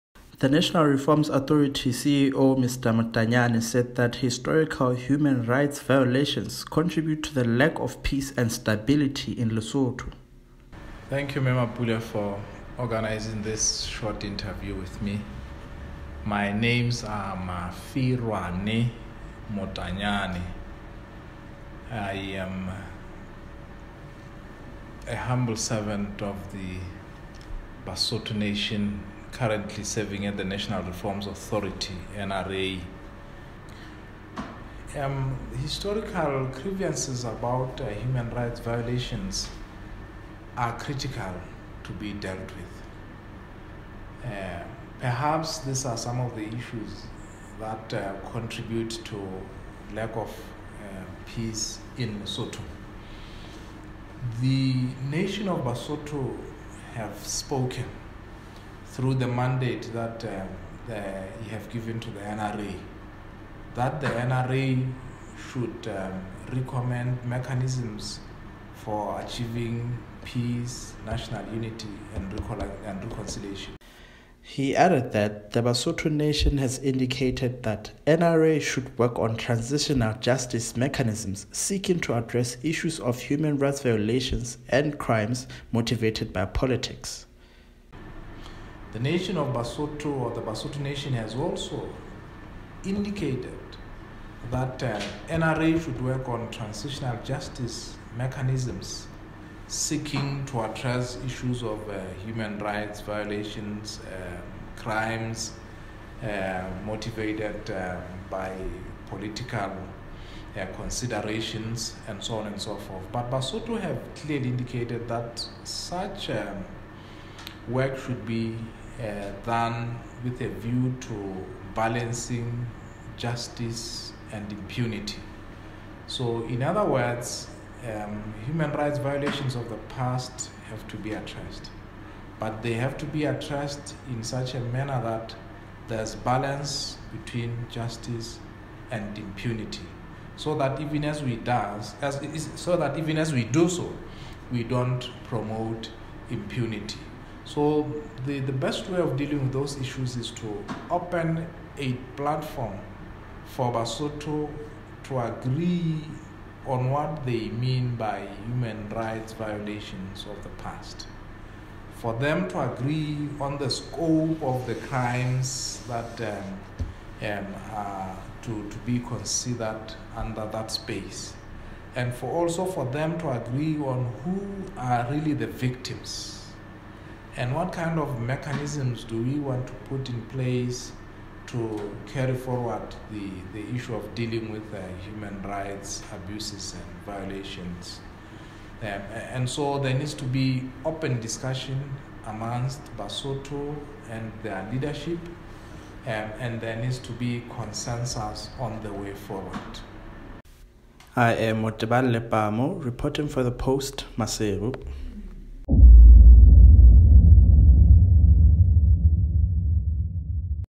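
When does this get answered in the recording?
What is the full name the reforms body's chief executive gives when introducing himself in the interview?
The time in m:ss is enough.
0:17.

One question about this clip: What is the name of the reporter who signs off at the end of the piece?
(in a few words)
Motebang Lepamo.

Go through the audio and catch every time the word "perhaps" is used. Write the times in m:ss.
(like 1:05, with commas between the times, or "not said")
0:44.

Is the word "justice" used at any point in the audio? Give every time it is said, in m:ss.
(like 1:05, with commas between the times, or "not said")
1:20, 1:37, 2:03, 2:17.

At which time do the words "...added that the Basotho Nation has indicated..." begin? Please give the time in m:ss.
1:14.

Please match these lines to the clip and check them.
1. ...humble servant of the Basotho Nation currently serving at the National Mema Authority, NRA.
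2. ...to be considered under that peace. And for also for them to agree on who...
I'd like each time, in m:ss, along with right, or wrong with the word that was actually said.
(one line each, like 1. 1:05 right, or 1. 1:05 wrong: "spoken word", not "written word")
1. 0:25 wrong: "Reforms", not "Mema"
2. 2:48 wrong: "space", not "peace".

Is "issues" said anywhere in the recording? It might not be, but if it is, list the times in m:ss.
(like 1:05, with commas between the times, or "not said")
0:46, 1:22, 1:41, 2:29, 3:03.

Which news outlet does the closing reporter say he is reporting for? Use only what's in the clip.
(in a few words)
the Post.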